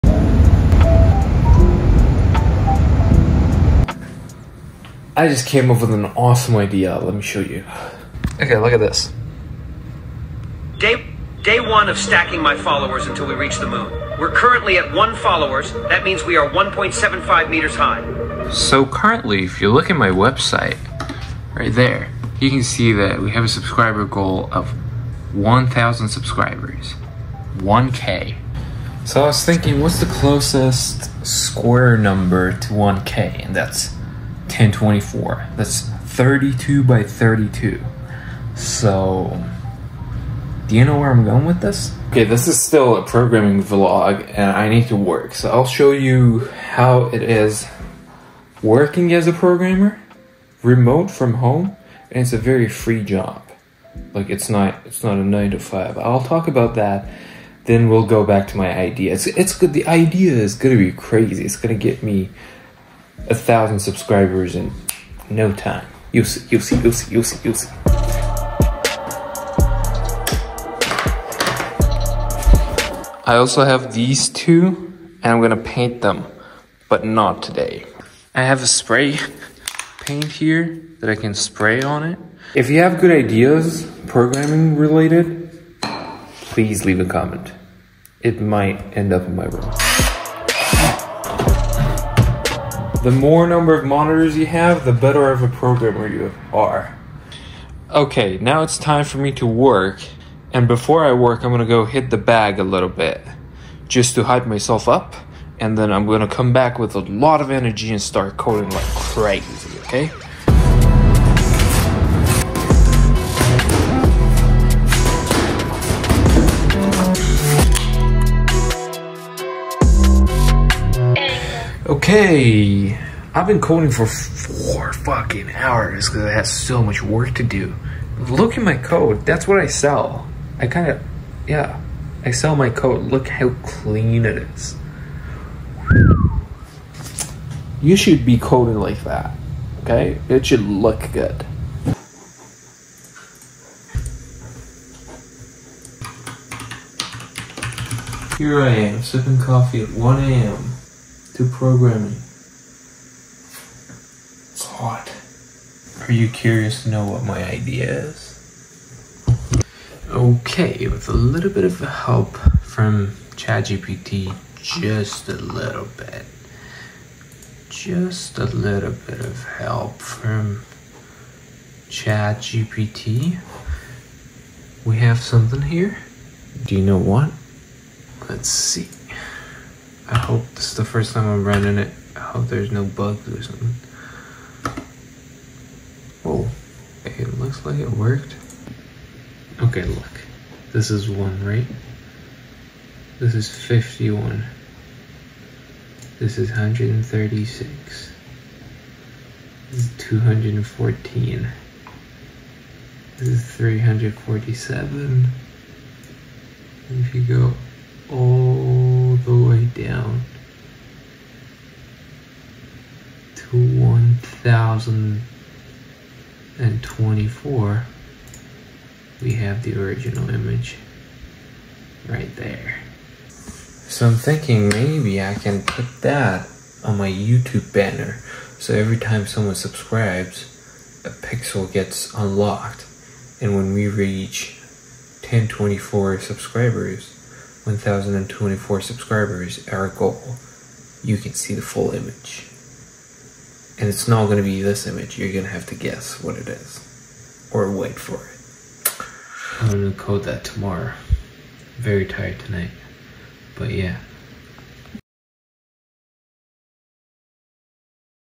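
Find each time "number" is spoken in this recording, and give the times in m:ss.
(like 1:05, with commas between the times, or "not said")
0:31, 1:33.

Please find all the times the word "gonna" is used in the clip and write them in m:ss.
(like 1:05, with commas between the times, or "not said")
1:15, 1:41, 1:46.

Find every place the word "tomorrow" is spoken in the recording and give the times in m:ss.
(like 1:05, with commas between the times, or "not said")
4:10.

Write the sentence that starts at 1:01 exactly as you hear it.
It's going to get me a thousand subscribers in no time.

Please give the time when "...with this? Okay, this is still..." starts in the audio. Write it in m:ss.
0:41.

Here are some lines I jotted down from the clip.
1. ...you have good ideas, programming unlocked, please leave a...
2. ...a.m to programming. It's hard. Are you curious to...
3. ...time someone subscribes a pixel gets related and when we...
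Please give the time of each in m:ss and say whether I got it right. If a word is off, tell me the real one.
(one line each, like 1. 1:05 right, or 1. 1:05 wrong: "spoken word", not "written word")
1. 1:22 wrong: "related", not "unlocked"
2. 2:30 right
3. 3:48 wrong: "unlocked", not "related".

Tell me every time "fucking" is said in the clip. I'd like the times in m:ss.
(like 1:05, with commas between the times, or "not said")
2:04.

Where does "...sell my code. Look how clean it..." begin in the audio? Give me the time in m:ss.
2:12.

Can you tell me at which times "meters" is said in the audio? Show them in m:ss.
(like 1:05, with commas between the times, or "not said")
0:17.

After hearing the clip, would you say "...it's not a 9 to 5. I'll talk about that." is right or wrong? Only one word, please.
right.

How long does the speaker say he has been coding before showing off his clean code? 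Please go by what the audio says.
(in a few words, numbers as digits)
4 hours.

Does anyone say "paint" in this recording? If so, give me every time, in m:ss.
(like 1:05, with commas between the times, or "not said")
1:15, 1:20.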